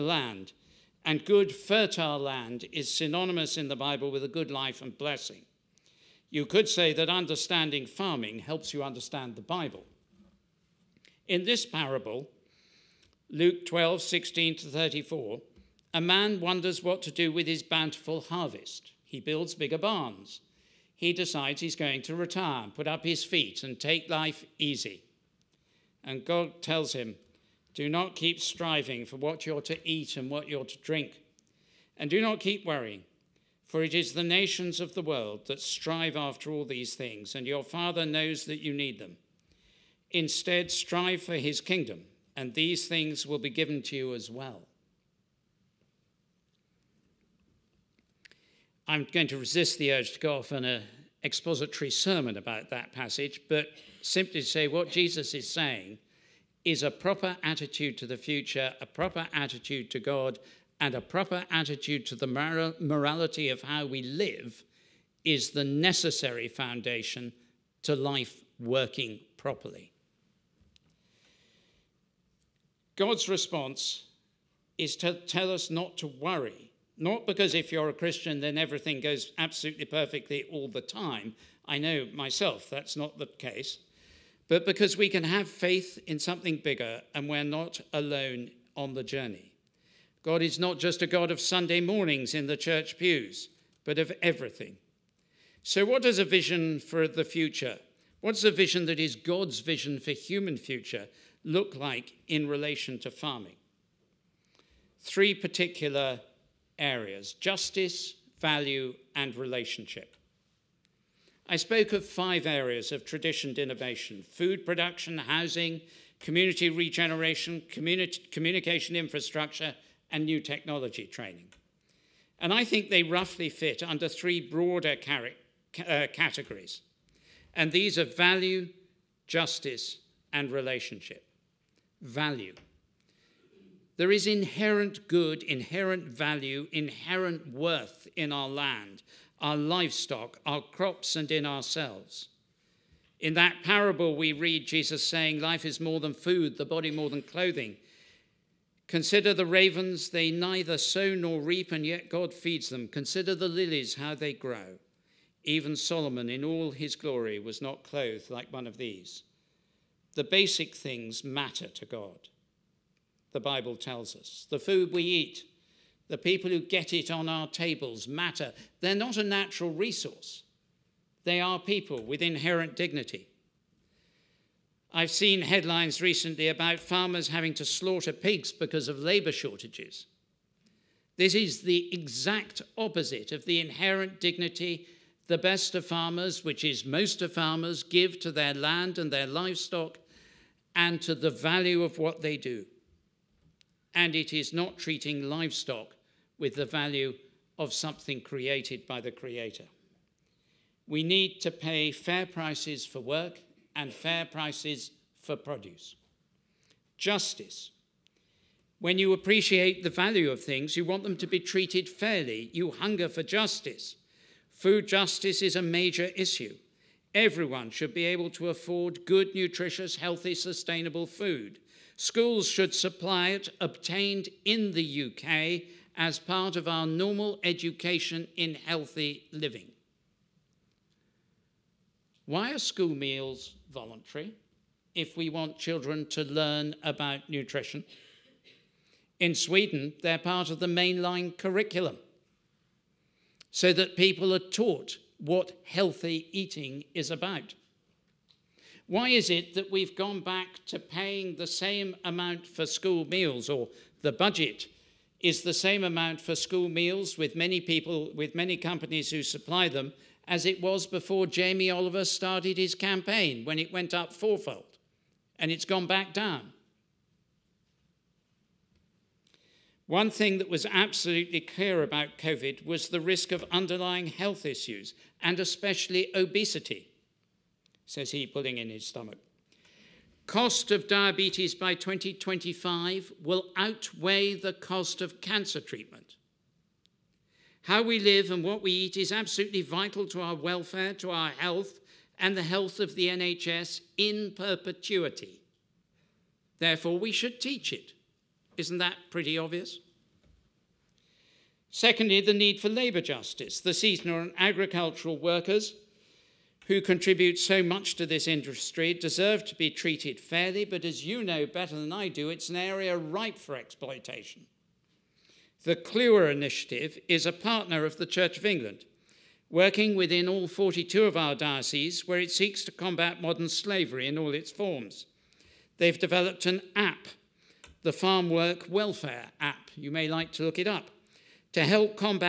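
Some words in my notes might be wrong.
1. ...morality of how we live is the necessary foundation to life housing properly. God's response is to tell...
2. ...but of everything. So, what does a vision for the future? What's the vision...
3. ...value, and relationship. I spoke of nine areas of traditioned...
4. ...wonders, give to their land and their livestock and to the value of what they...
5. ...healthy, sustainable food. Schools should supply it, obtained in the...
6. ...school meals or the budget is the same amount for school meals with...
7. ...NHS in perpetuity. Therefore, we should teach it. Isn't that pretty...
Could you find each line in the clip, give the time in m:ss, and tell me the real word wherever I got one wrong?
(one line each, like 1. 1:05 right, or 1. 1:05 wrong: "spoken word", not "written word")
1. 1:02 wrong: "working", not "housing"
2. 1:33 right
3. 1:48 wrong: "five", not "nine"
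4. 3:07 wrong: "farmers", not "wonders"
5. 3:39 right
6. 4:12 right
7. 4:53 right.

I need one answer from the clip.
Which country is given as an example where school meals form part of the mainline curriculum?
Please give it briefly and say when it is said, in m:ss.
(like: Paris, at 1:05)
Sweden, at 3:59.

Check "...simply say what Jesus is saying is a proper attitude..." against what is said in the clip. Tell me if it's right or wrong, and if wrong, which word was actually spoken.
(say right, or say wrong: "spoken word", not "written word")
right.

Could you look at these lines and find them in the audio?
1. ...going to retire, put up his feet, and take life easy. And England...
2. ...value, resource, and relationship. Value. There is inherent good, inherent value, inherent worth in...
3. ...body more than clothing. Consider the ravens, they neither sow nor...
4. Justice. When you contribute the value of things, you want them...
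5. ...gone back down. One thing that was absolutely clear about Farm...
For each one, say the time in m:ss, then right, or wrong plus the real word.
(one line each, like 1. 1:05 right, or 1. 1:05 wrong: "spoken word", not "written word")
1. 0:21 wrong: "God", not "England"
2. 2:08 wrong: "justice", not "resource"
3. 2:26 right
4. 3:26 wrong: "appreciate", not "contribute"
5. 4:25 wrong: "COVID", not "Farm".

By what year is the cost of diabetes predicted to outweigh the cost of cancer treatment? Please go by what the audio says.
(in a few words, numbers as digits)
2025.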